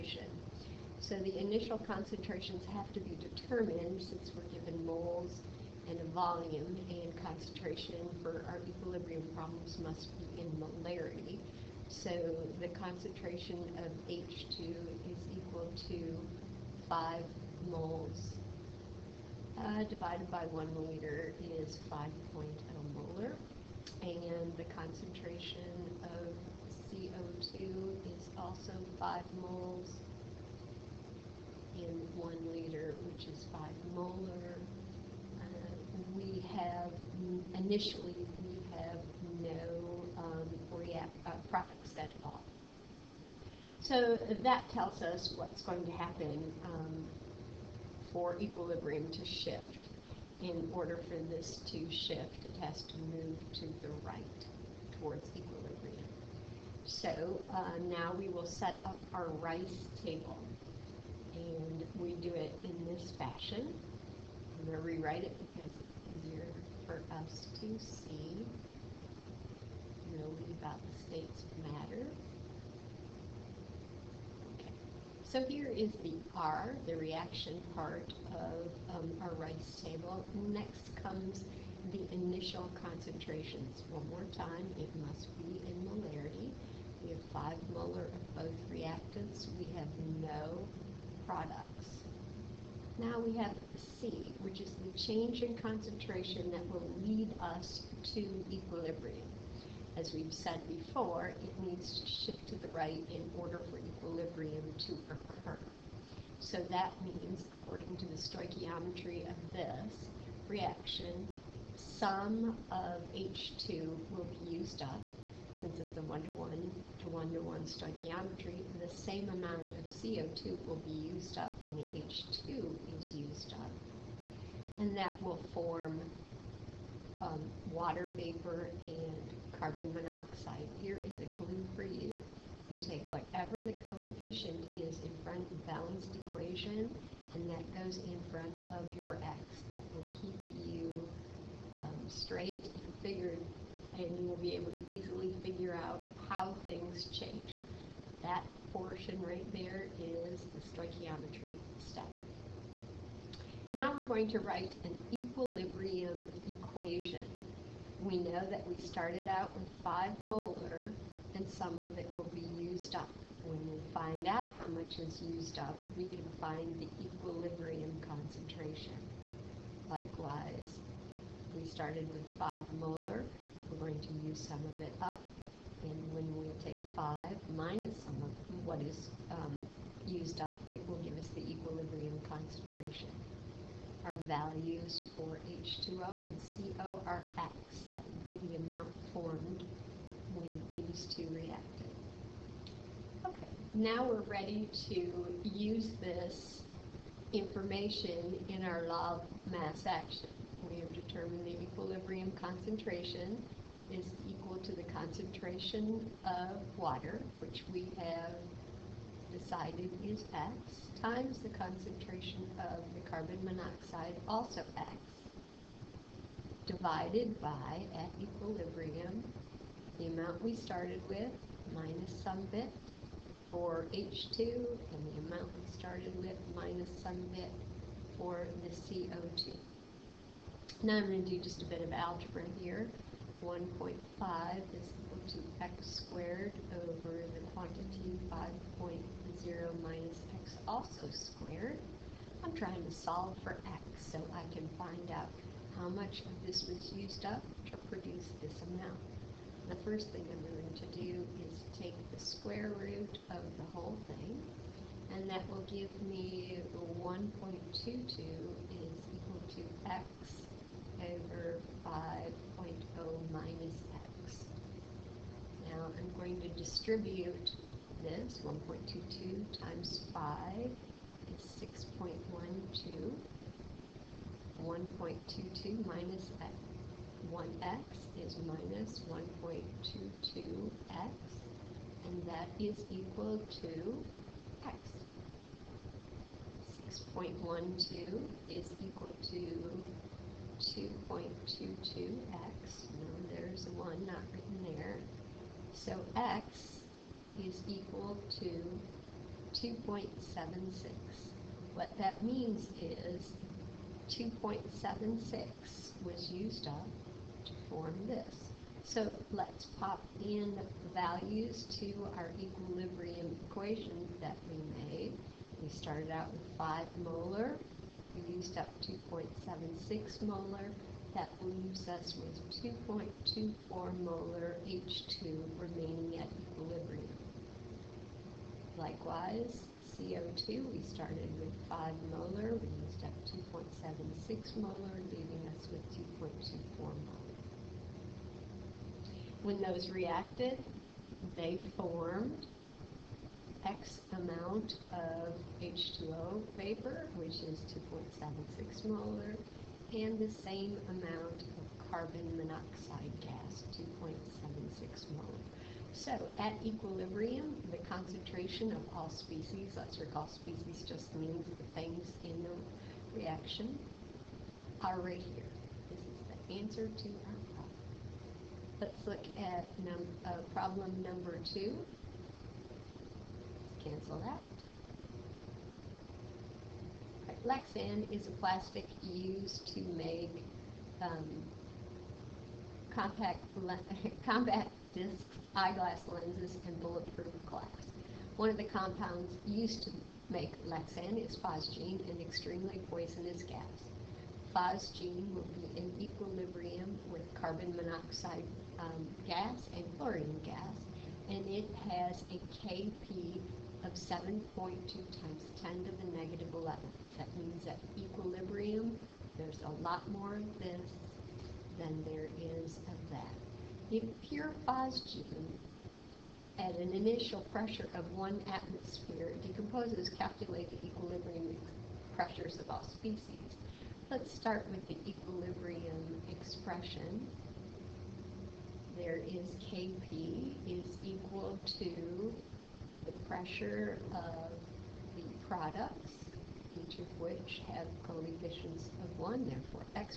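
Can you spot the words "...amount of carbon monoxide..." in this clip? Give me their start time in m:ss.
5:50.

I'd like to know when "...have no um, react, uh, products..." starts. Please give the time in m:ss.
0:38.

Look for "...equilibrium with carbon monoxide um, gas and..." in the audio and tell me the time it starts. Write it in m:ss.
6:36.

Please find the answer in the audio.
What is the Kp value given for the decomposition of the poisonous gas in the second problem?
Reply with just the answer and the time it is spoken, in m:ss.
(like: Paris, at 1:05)
7.2 x 10^-11, at 6:43.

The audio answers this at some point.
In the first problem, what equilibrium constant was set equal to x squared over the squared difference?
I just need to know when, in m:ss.
3:53.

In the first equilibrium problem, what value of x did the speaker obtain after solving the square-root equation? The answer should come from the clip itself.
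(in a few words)
2.76.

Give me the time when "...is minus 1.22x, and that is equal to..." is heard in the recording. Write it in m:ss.
4:38.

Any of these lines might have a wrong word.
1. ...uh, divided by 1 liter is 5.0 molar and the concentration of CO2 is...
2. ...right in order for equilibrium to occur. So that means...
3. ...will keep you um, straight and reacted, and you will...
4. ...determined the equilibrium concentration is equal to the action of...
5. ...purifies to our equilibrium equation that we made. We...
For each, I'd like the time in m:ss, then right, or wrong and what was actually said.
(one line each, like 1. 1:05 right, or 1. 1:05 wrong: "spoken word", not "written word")
1. 0:19 right
2. 1:42 right
3. 2:19 wrong: "figured", not "reacted"
4. 3:20 wrong: "concentration", not "action"
5. 5:10 wrong: "values", not "purifies".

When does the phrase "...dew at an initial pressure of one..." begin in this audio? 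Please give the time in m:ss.
6:55.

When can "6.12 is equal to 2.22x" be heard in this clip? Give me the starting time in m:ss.
4:47.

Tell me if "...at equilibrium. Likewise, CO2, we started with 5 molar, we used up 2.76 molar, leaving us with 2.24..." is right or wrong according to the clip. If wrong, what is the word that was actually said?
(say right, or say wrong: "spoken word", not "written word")
right.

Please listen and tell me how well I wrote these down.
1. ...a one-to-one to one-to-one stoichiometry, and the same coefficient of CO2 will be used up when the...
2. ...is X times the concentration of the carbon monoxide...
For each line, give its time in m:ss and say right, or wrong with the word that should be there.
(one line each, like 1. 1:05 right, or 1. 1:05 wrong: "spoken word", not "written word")
1. 1:55 wrong: "amount", not "coefficient"
2. 3:30 right.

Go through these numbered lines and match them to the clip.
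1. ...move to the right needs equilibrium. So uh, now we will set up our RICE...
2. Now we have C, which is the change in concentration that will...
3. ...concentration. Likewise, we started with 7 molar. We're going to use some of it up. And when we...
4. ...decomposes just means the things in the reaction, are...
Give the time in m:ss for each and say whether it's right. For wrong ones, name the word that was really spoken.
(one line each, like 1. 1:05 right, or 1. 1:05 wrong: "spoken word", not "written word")
1. 0:52 wrong: "towards", not "needs"
2. 1:32 right
3. 2:48 wrong: "5", not "7"
4. 6:00 wrong: "species", not "decomposes".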